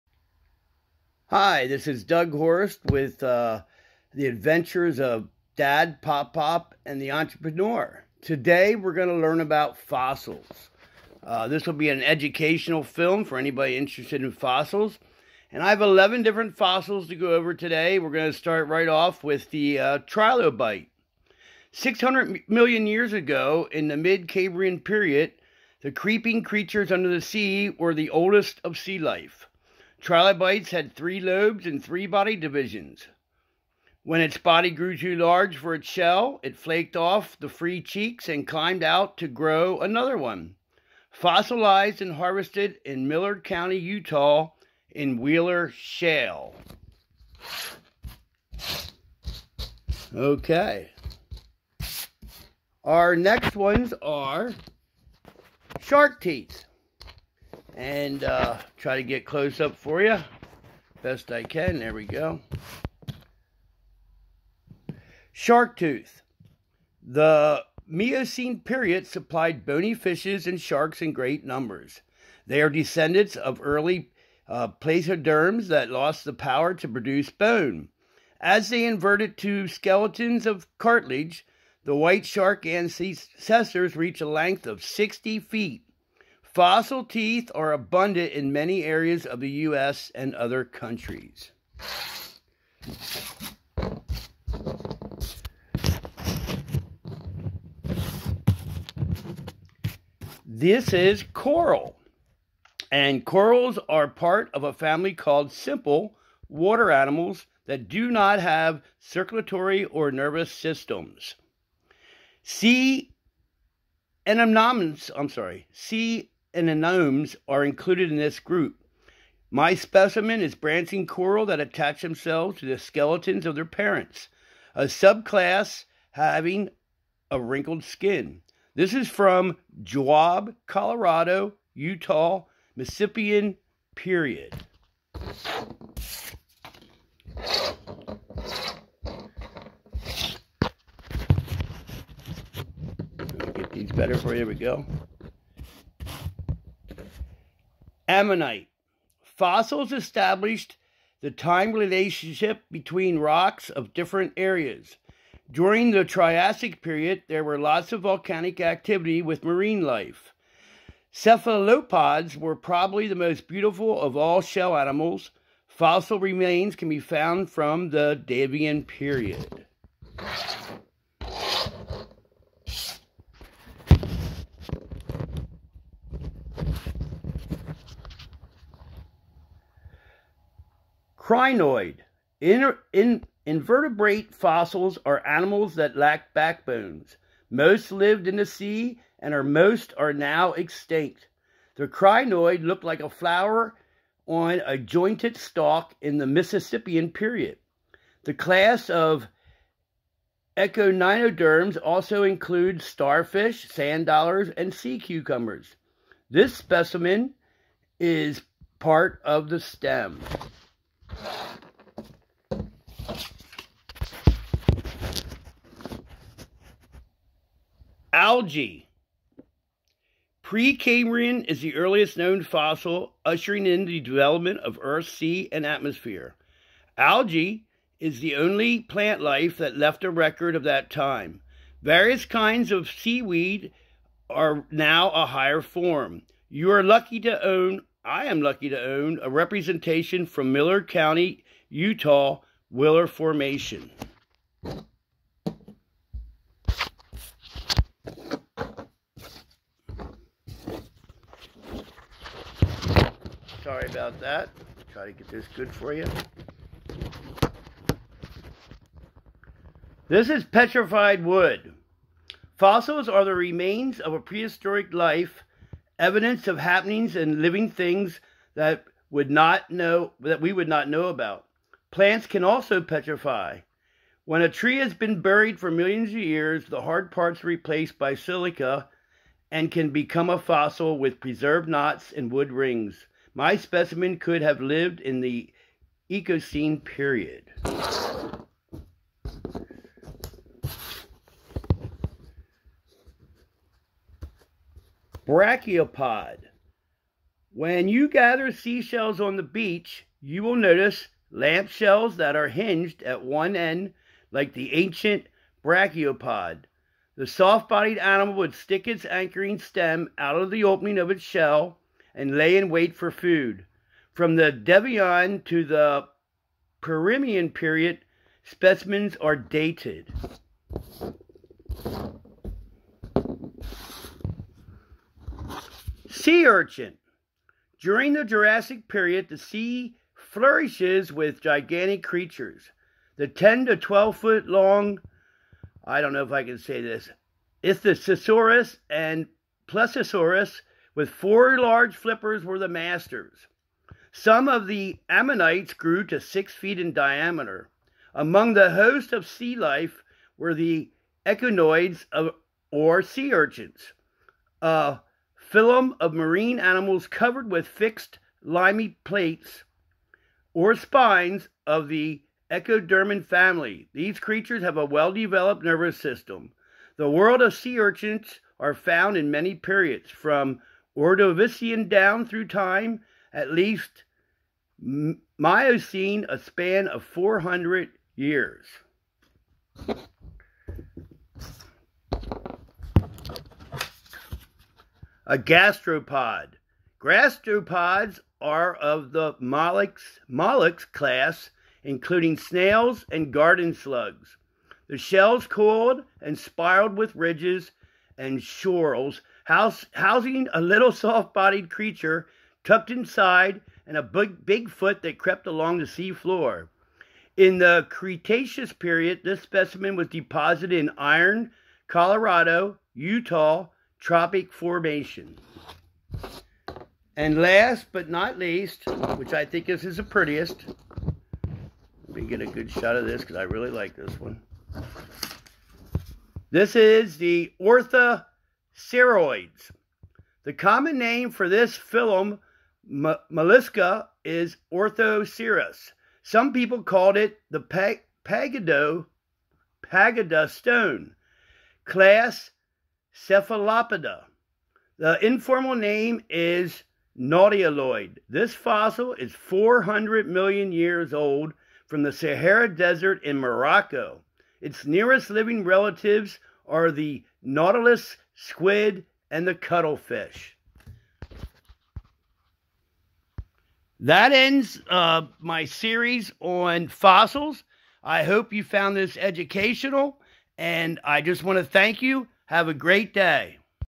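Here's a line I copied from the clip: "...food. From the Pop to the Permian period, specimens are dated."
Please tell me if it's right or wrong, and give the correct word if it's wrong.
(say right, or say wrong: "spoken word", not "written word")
wrong: "Devonian", not "Pop".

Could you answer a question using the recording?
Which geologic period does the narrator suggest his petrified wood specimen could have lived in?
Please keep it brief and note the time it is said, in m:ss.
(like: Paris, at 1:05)
Eocene, at 4:46.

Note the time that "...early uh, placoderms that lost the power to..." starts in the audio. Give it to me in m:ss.
1:13.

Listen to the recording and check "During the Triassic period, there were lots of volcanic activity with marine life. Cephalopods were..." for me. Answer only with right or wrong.
right.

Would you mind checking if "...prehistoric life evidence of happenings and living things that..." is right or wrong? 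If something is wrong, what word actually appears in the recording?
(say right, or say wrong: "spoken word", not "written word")
right.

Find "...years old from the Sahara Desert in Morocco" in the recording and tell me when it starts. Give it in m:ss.
7:30.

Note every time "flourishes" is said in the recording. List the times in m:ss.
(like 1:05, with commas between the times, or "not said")
5:30.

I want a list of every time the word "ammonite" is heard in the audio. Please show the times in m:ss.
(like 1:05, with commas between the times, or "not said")
2:28, 5:45.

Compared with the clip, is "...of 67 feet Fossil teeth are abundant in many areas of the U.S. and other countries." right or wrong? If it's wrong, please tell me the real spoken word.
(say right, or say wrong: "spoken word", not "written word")
wrong: "60", not "67".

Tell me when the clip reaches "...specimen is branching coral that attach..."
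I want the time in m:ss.
1:59.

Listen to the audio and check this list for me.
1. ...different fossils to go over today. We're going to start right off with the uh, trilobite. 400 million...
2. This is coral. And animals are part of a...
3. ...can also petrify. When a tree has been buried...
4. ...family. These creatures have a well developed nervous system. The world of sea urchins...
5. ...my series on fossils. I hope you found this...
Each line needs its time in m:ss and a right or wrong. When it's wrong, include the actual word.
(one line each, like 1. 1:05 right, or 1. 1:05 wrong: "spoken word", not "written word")
1. 0:16 wrong: "600", not "400"
2. 1:40 wrong: "corals", not "animals"
3. 4:32 right
4. 6:03 right
5. 7:45 right.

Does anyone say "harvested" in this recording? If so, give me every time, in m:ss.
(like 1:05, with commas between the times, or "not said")
0:42.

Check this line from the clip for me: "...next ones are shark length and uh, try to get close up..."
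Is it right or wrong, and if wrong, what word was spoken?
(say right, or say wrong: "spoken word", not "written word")
wrong: "teeth", not "length".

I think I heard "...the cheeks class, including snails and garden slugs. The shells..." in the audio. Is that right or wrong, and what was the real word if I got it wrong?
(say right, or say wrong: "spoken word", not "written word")
wrong: "mollusks", not "cheeks".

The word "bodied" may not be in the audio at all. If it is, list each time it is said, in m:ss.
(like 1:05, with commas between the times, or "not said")
5:07, 6:41.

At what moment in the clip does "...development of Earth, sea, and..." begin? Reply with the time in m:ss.
3:44.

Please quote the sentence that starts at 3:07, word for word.
Most lived in the sea and are most are now extinct.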